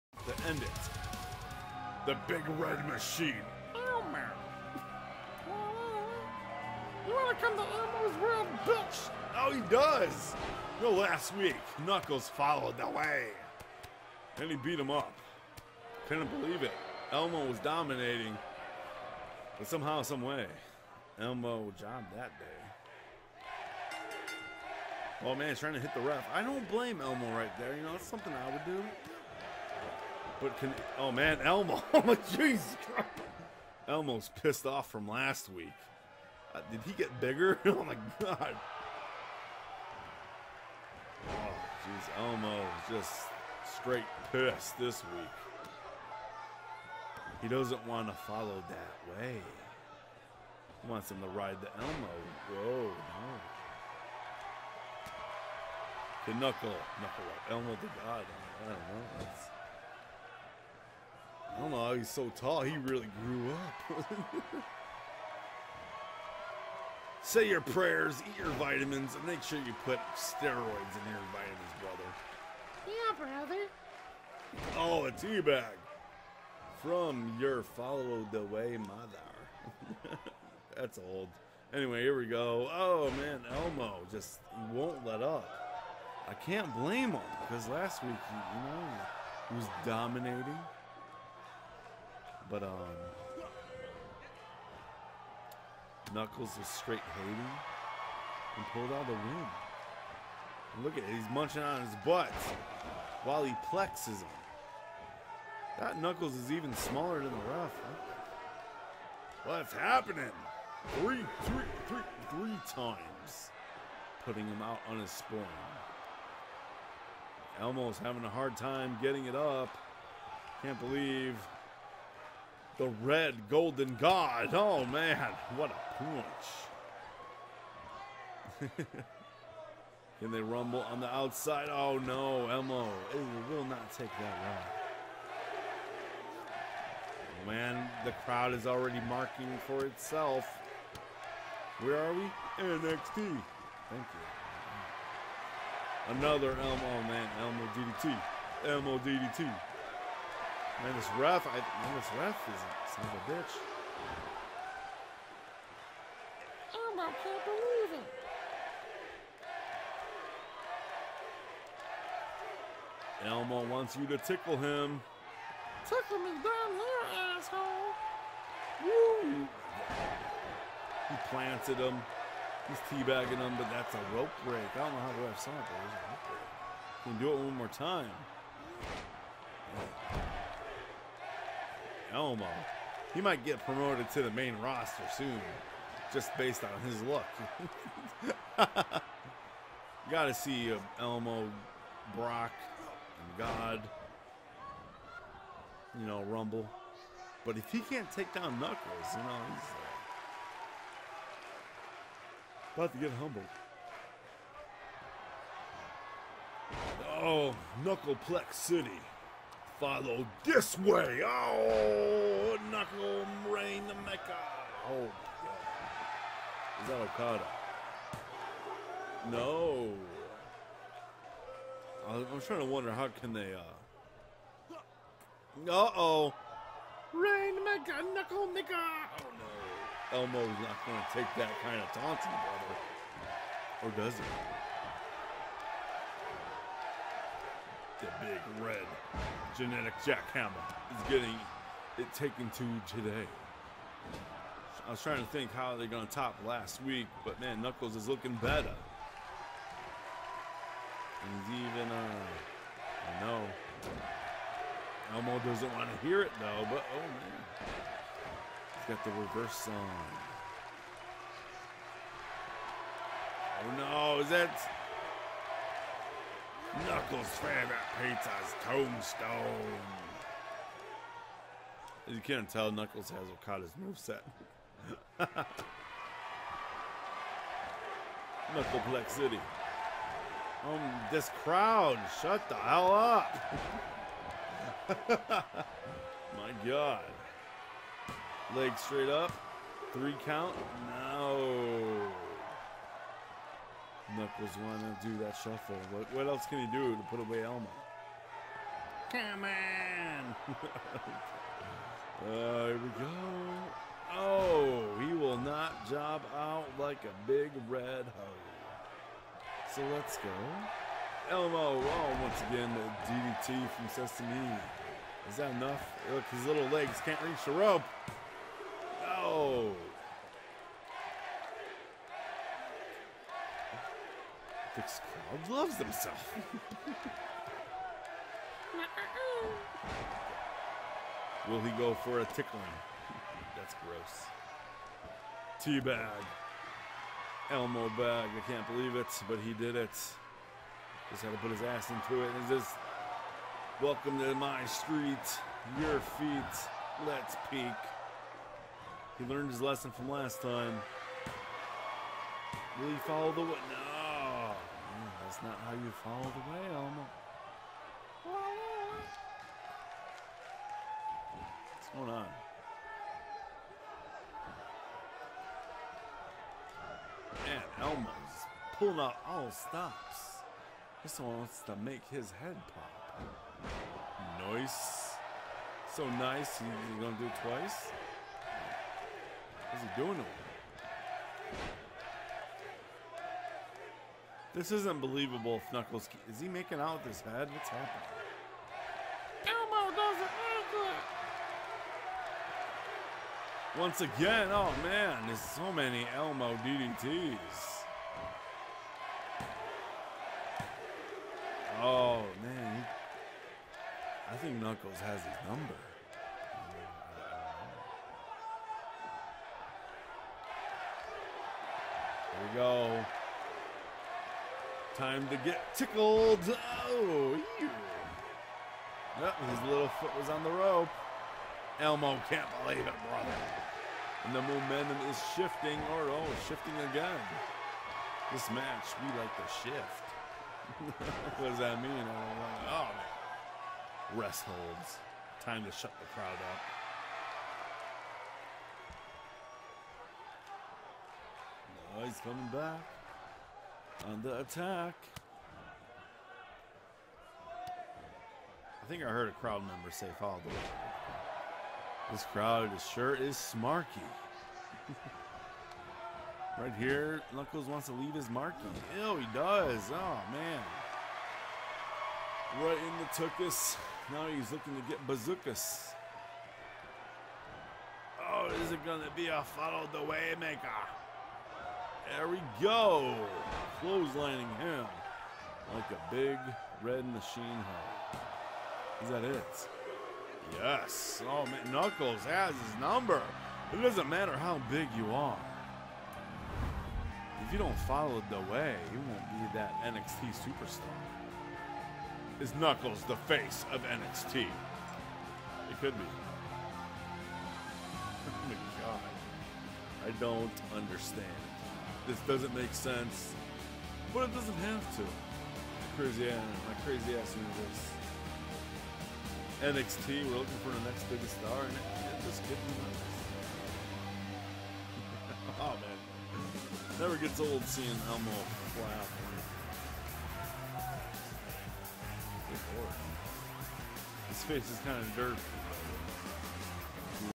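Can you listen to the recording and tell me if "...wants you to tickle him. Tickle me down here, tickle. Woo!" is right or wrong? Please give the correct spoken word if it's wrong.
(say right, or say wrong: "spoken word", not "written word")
wrong: "asshole", not "tickle".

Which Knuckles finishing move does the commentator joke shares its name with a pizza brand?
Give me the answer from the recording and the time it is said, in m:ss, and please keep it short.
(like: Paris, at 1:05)
Tombstone, at 4:28.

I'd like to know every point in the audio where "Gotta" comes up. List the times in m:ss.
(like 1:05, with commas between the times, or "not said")
3:10.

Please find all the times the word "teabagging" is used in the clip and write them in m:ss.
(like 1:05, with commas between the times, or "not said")
2:52.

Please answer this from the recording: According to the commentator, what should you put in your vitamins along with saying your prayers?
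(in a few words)
Steroids.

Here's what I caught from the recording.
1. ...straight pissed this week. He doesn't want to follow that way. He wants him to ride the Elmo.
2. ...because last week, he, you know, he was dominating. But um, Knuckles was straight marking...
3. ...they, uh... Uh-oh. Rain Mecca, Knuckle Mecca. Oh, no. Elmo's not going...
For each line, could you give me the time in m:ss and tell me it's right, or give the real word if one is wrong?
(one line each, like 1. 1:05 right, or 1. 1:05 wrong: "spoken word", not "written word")
1. 0:43 right
2. 1:27 wrong: "hating", not "marking"
3. 3:43 right.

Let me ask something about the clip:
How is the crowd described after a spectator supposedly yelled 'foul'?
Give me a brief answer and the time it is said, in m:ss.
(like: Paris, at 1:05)
Smarky, at 7:33.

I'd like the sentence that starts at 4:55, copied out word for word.
What, what else can he do to put away Elmo?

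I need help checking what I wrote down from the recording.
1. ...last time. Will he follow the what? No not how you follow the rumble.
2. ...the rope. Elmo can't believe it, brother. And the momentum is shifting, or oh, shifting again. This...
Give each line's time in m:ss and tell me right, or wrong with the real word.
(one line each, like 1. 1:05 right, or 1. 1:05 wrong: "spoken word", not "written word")
1. 5:50 wrong: "whale", not "rumble"
2. 7:00 right.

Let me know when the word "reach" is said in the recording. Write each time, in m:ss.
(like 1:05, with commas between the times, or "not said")
5:17.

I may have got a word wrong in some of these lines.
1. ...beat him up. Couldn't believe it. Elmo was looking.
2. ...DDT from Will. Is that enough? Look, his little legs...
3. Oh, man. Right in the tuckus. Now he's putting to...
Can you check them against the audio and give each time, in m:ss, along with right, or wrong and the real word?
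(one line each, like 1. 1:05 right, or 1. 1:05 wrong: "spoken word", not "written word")
1. 0:14 wrong: "dominating", not "looking"
2. 5:13 wrong: "Sesame", not "Will"
3. 7:39 wrong: "looking", not "putting".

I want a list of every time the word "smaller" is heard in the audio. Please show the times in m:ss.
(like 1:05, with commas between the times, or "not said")
1:46.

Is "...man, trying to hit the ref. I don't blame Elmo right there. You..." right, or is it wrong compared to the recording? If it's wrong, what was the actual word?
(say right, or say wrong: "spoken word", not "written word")
right.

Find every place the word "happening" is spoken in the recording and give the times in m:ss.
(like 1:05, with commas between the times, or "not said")
1:49, 6:27.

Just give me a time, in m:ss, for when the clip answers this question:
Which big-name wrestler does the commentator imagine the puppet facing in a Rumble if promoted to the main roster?
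3:12.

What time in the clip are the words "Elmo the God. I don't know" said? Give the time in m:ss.
0:57.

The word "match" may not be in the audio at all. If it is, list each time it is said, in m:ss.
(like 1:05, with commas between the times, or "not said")
7:08.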